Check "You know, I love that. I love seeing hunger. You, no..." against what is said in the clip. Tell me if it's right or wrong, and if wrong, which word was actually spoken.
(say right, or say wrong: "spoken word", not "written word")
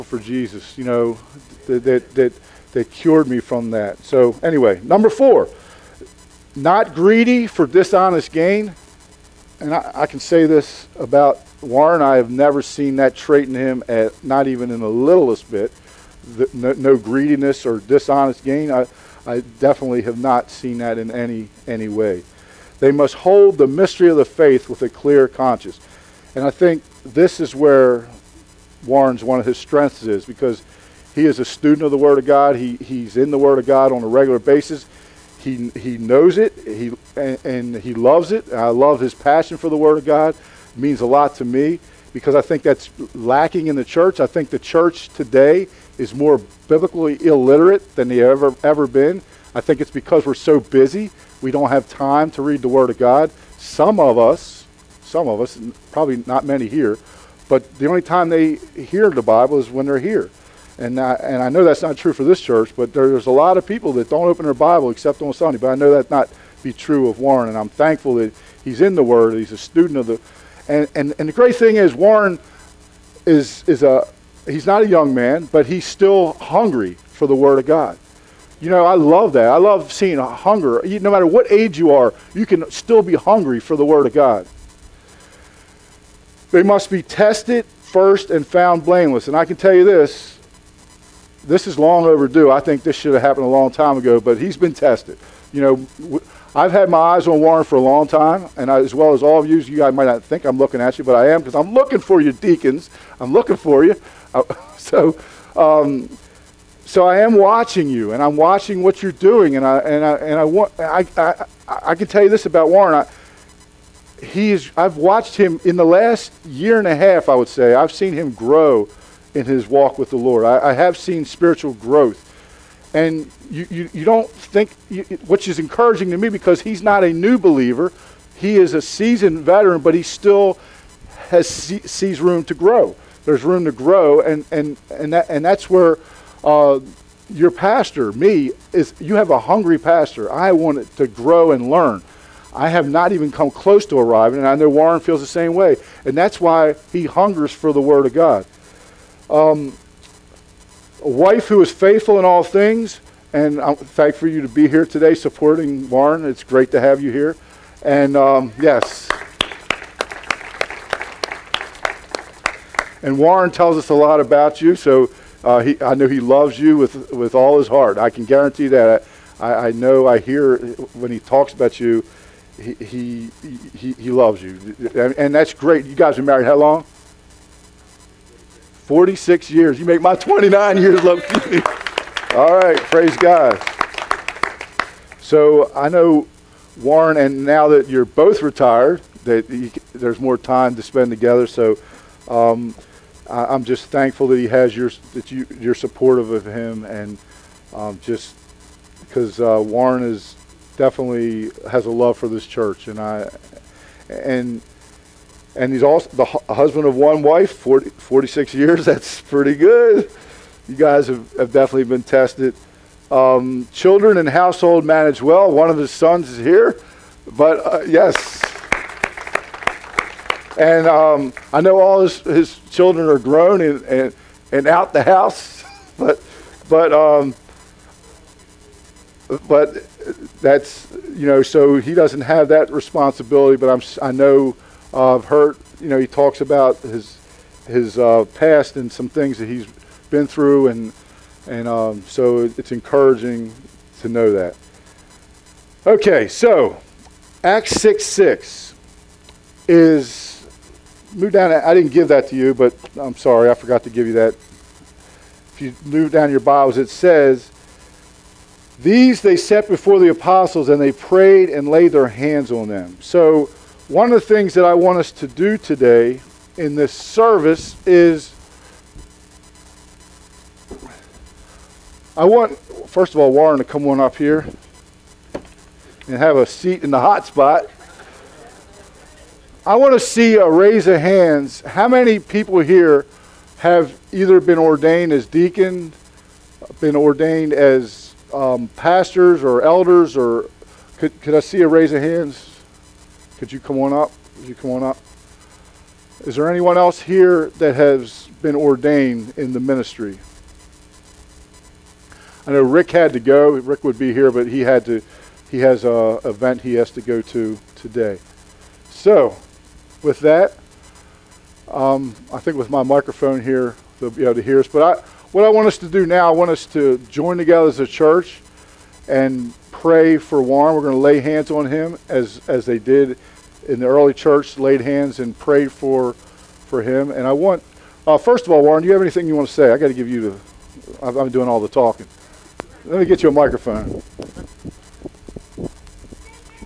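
right.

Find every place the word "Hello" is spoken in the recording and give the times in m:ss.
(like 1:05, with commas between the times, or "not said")
not said.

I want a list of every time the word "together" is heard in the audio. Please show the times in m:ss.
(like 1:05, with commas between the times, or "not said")
3:11, 5:17.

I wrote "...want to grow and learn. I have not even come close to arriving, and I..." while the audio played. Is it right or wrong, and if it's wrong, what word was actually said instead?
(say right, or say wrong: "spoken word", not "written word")
right.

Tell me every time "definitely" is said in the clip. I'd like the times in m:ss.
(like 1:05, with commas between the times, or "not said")
0:19, 3:20, 3:31.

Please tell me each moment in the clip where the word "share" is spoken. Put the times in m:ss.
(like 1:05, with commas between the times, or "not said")
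not said.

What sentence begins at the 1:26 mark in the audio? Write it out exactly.
They must be tested first and found blameless.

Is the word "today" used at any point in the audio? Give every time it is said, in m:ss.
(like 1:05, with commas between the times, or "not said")
0:45, 2:34, 4:25, 5:07.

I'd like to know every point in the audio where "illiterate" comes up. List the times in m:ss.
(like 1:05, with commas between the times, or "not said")
0:47.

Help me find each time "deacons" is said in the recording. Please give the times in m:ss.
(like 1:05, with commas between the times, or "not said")
1:42, 4:45.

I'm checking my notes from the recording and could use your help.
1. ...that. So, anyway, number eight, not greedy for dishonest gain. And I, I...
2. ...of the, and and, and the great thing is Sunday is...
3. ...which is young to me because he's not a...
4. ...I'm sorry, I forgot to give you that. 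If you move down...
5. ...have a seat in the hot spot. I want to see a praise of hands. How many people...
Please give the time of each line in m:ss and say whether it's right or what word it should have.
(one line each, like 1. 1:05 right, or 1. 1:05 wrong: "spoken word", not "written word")
1. 0:03 wrong: "four", not "eight"
2. 1:09 wrong: "Warren", not "Sunday"
3. 2:05 wrong: "encouraging", not "young"
4. 4:13 right
5. 4:36 wrong: "raise", not "praise".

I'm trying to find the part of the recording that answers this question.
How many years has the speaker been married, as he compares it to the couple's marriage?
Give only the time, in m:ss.
3:00.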